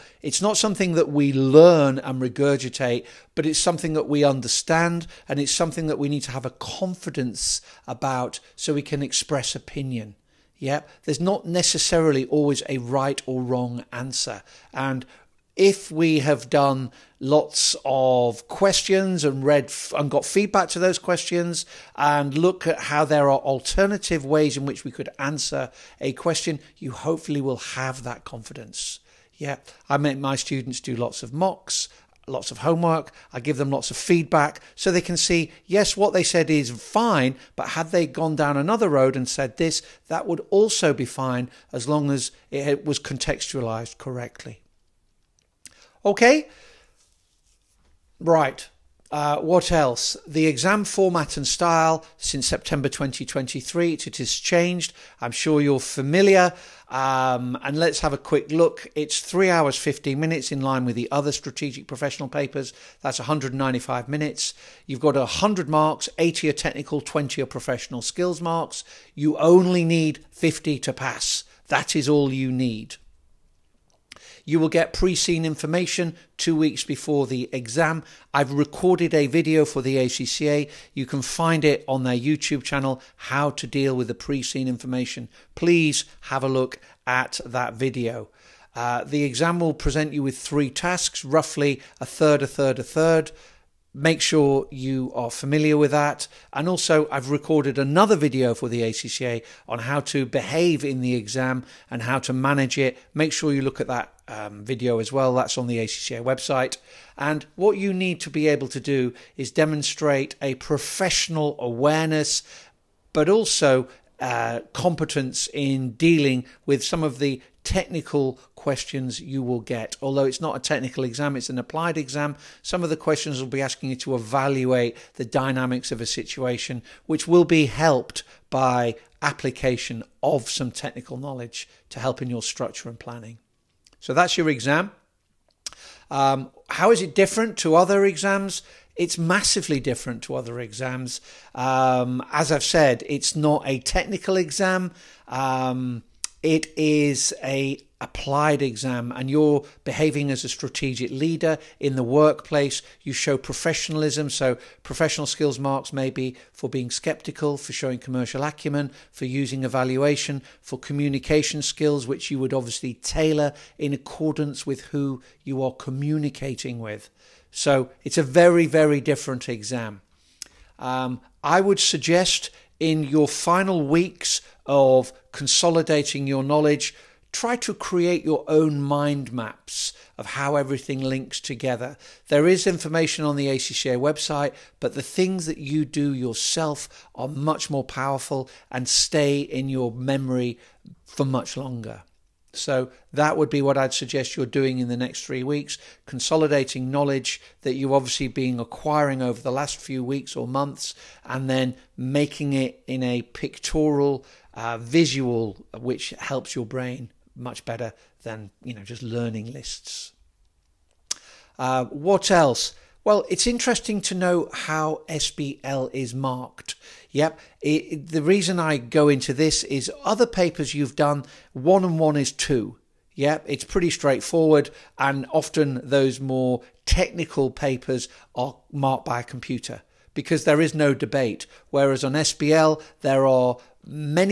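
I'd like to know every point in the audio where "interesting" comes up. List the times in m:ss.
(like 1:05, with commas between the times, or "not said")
3:33.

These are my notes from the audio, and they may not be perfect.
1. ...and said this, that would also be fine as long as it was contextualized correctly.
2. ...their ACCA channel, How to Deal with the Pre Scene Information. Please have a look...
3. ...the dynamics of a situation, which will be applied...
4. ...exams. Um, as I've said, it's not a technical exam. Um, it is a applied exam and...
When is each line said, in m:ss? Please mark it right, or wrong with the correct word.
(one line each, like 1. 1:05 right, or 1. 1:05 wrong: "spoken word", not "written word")
1. 0:39 right
2. 1:22 wrong: "YouTube", not "ACCA"
3. 2:05 wrong: "helped", not "applied"
4. 2:20 right.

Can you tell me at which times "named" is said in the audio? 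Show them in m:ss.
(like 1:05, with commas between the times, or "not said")
not said.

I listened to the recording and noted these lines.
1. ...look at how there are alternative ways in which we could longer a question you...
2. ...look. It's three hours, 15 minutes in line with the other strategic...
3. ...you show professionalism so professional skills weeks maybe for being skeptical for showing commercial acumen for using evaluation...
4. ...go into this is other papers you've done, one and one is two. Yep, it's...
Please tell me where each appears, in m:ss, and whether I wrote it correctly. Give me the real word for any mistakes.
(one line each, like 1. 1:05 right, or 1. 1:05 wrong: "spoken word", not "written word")
1. 0:22 wrong: "answer", not "longer"
2. 0:58 right
3. 2:33 wrong: "marks", not "weeks"
4. 3:38 right.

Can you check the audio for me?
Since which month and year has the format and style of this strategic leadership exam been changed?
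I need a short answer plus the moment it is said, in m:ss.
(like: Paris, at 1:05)
September 2023, at 0:52.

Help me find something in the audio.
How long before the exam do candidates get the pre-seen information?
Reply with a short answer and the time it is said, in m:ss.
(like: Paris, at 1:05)
2 weeks, at 1:16.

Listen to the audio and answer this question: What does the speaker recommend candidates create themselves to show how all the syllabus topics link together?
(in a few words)
mind maps.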